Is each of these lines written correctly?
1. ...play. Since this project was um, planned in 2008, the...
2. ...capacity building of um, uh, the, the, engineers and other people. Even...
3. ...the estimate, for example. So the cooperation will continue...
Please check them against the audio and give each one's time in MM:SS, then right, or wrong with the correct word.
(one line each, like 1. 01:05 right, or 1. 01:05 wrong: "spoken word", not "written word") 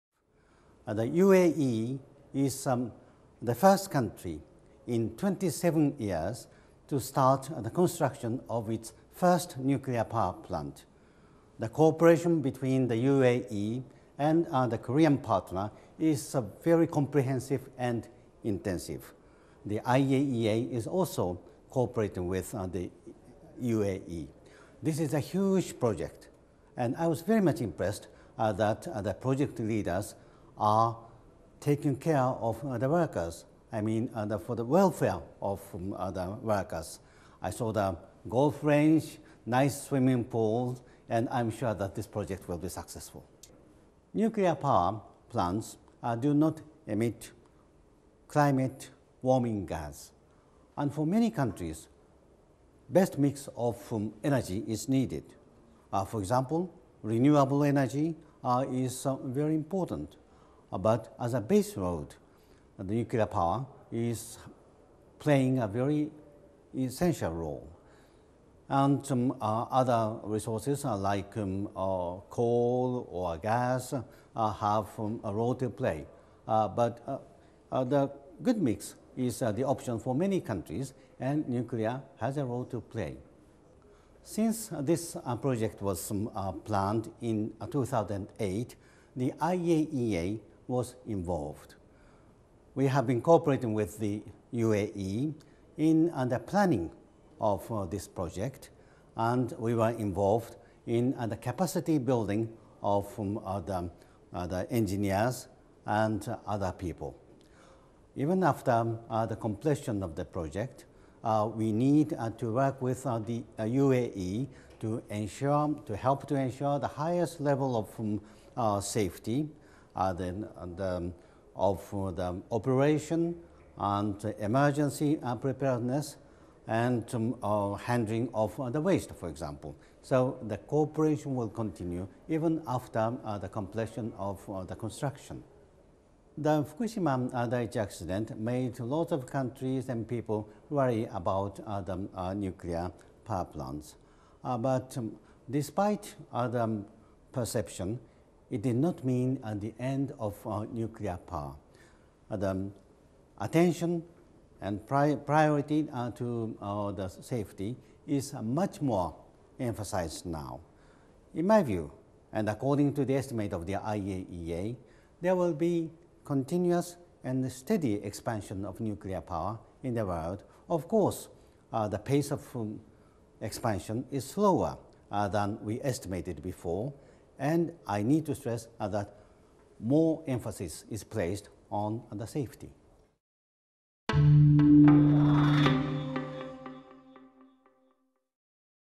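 1. 01:22 right
2. 01:41 right
3. 02:08 wrong: "waste", not "estimate".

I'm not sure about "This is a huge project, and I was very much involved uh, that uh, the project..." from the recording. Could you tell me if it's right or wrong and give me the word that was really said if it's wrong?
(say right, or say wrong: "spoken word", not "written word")
wrong: "impressed", not "involved".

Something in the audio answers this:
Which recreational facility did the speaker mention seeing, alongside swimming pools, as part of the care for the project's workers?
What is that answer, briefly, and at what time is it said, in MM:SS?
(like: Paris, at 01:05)
golf range, at 00:38.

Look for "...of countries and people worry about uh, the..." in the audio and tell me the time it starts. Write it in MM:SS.
02:19.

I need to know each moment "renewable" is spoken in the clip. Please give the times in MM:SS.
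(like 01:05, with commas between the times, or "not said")
00:57.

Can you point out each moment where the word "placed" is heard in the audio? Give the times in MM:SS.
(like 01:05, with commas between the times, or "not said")
03:01.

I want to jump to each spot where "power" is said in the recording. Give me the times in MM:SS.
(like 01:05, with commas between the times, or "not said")
00:10, 00:44, 01:03, 02:23, 02:31, 02:49.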